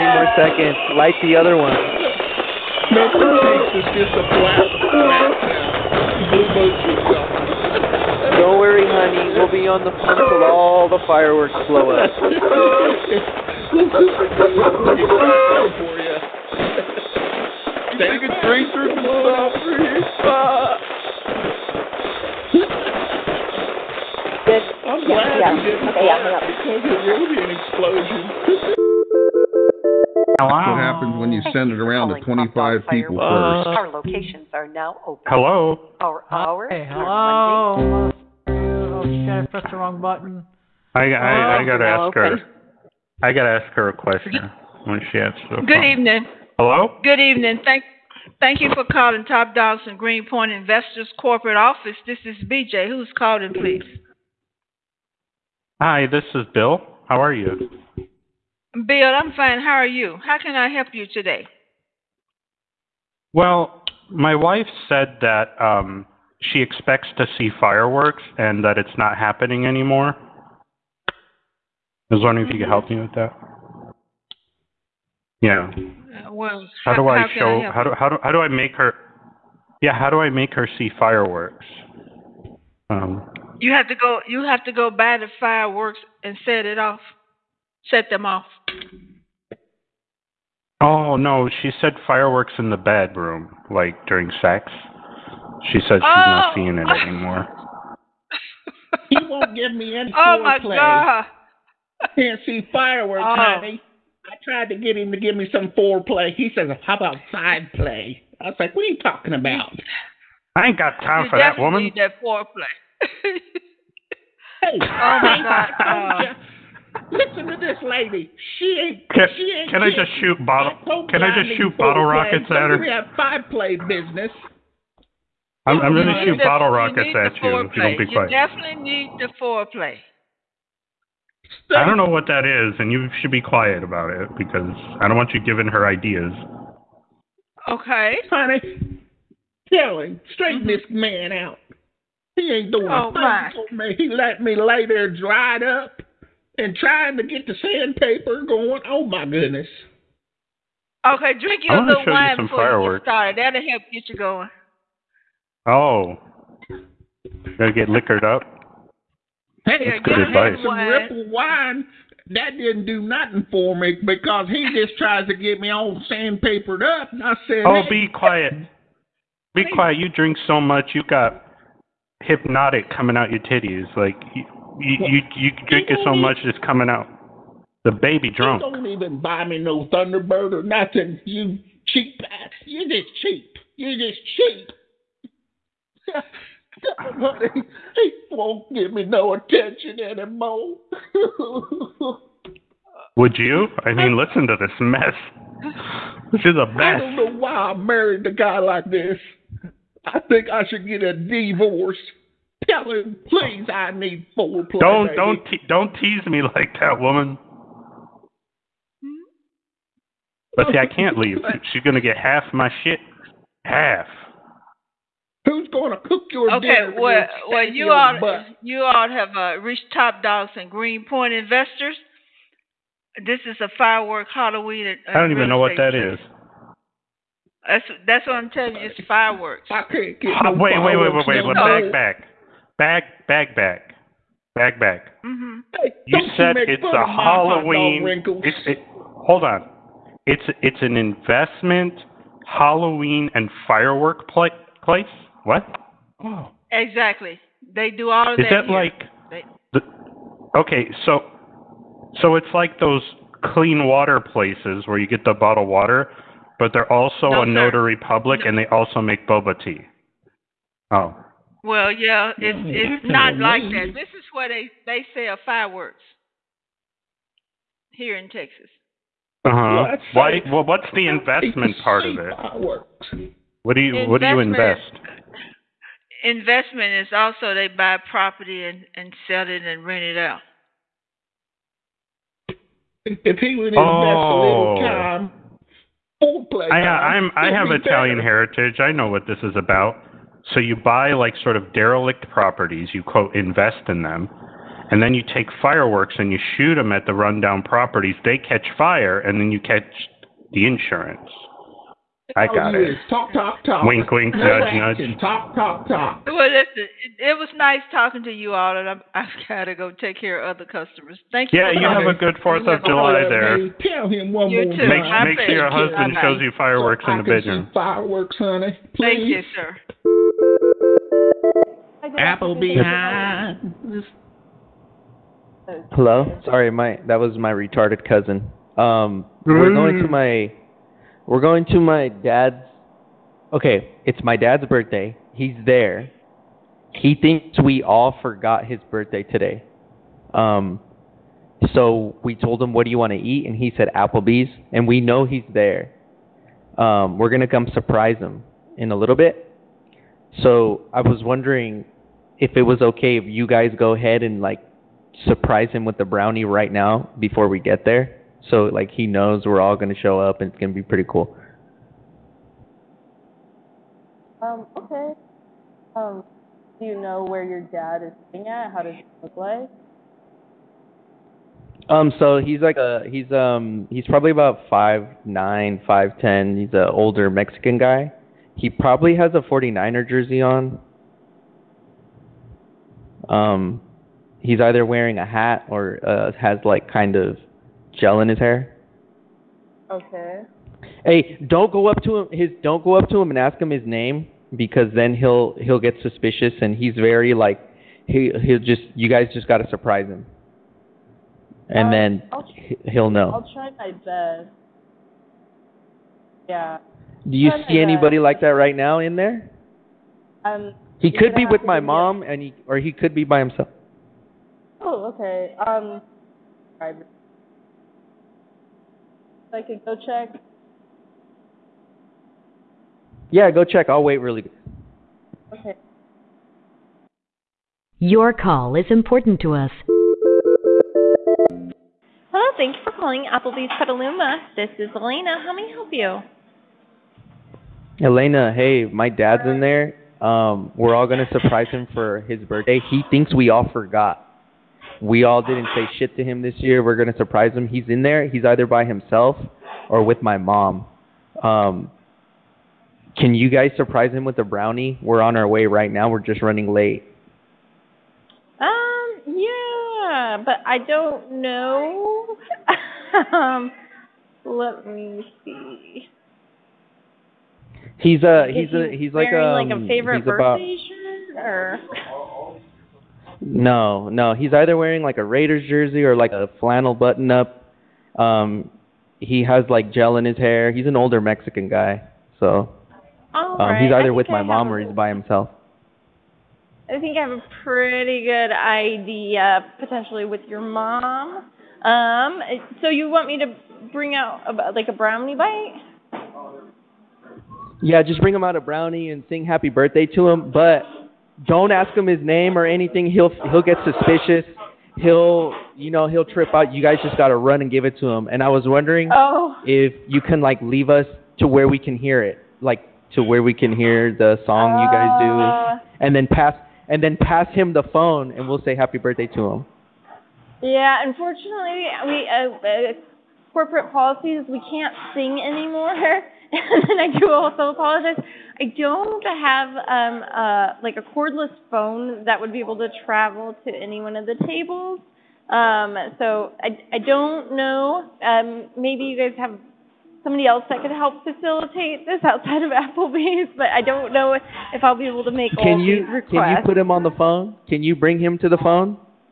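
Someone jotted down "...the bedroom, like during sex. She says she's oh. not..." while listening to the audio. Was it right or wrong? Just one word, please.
right.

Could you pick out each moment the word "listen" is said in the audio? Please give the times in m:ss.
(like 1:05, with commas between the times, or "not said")
1:57, 3:14, 5:06.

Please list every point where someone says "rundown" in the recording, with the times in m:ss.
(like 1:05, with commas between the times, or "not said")
4:57.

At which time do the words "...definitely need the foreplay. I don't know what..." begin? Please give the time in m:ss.
2:08.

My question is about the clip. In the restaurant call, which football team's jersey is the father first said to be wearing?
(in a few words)
49ers.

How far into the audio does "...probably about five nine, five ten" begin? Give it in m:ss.
6:14.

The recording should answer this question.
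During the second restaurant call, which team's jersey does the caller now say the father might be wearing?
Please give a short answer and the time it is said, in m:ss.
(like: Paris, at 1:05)
Raiders, at 7:55.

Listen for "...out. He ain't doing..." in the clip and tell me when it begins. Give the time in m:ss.
2:21.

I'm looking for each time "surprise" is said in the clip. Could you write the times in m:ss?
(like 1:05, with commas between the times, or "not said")
5:47, 5:55, 6:39, 7:21, 7:27, 7:33.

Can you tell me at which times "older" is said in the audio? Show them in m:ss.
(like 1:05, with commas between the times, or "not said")
6:16, 8:00.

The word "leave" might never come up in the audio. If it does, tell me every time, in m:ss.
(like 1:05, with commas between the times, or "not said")
3:31, 8:30.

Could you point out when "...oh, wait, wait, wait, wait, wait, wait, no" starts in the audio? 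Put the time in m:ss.
3:50.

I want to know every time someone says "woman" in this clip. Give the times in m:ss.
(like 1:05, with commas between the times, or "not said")
1:51, 3:26.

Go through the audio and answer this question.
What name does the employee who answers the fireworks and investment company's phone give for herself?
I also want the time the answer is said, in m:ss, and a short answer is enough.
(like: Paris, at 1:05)
BJ, at 0:52.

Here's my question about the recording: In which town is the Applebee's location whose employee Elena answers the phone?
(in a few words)
Petaluma.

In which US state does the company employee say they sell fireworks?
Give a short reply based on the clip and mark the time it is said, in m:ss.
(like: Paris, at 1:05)
Texas, at 4:28.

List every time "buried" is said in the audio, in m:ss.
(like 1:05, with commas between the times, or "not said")
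not said.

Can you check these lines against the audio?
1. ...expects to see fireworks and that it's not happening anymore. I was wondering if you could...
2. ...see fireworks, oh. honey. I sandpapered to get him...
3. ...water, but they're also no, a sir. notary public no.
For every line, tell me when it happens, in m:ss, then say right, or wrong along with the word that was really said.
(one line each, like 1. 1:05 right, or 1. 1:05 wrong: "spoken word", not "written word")
1. 1:06 right
2. 1:42 wrong: "tried", not "sandpapered"
3. 4:15 right.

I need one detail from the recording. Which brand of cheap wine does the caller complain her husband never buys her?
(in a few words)
Thunderbird.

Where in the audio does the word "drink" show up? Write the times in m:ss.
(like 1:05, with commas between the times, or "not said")
2:31, 2:50, 2:55.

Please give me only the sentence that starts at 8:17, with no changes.
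Yeah, just bring him out a brownie and sing happy birthday to him, but don't ask him his name or anything.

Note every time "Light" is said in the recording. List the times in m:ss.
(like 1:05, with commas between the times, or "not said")
0:01.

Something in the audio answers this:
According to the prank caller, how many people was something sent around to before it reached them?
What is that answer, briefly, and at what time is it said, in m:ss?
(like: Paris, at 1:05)
25, at 0:32.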